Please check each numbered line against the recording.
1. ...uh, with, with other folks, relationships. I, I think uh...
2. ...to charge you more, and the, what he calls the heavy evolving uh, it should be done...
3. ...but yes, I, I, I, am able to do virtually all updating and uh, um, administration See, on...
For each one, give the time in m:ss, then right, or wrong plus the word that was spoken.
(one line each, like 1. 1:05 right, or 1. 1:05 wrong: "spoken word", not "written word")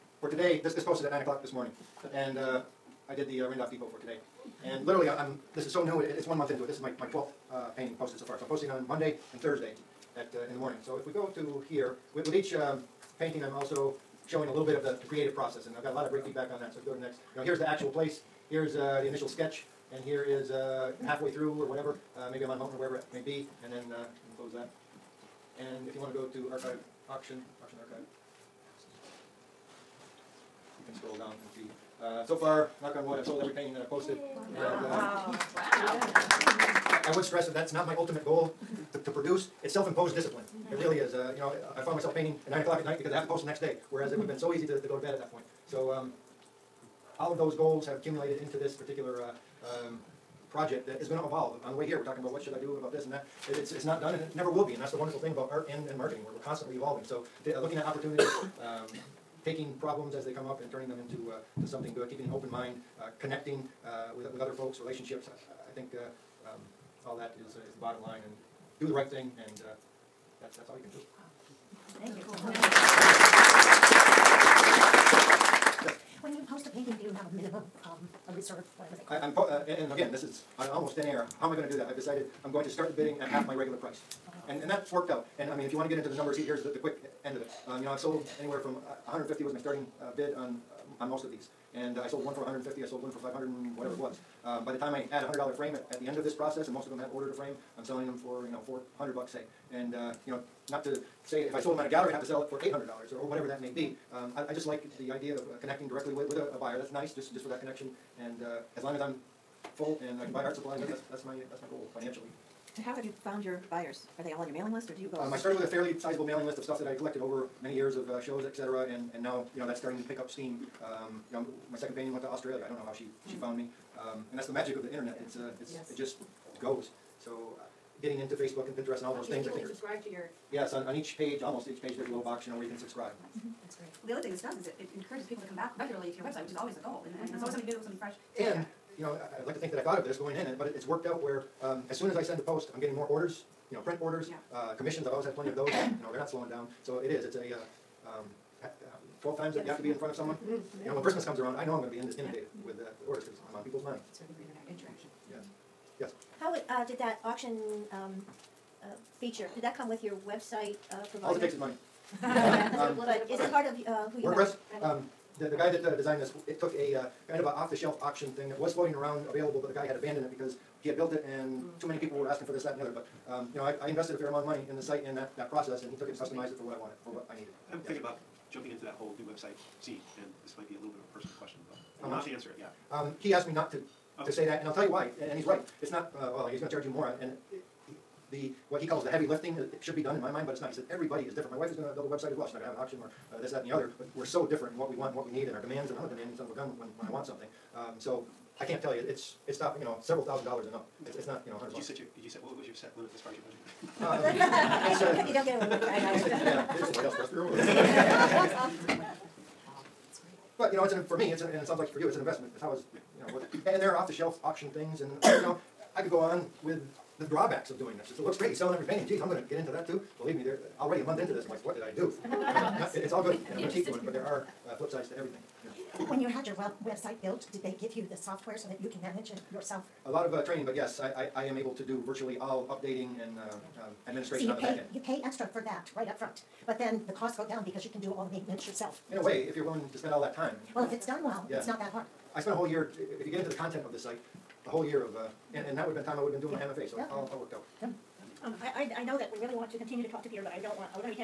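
1. 1:03 right
2. 3:06 wrong: "lifting", not "evolving"
3. 3:50 right.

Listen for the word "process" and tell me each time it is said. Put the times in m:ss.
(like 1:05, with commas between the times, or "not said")
0:15, 1:36, 2:55.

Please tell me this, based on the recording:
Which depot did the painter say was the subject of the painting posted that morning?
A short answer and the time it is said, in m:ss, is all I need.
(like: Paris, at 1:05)
Randolph Depot, at 0:03.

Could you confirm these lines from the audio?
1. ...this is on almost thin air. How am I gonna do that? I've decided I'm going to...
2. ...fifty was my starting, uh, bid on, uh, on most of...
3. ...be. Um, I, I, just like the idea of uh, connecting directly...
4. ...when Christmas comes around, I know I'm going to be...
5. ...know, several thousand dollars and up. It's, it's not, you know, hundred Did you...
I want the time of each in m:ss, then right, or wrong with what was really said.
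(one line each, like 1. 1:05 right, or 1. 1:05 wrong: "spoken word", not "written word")
1. 1:20 right
2. 1:29 right
3. 1:43 right
4. 2:30 right
5. 3:19 right.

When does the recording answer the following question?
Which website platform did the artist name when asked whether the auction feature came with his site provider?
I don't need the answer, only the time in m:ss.
2:44.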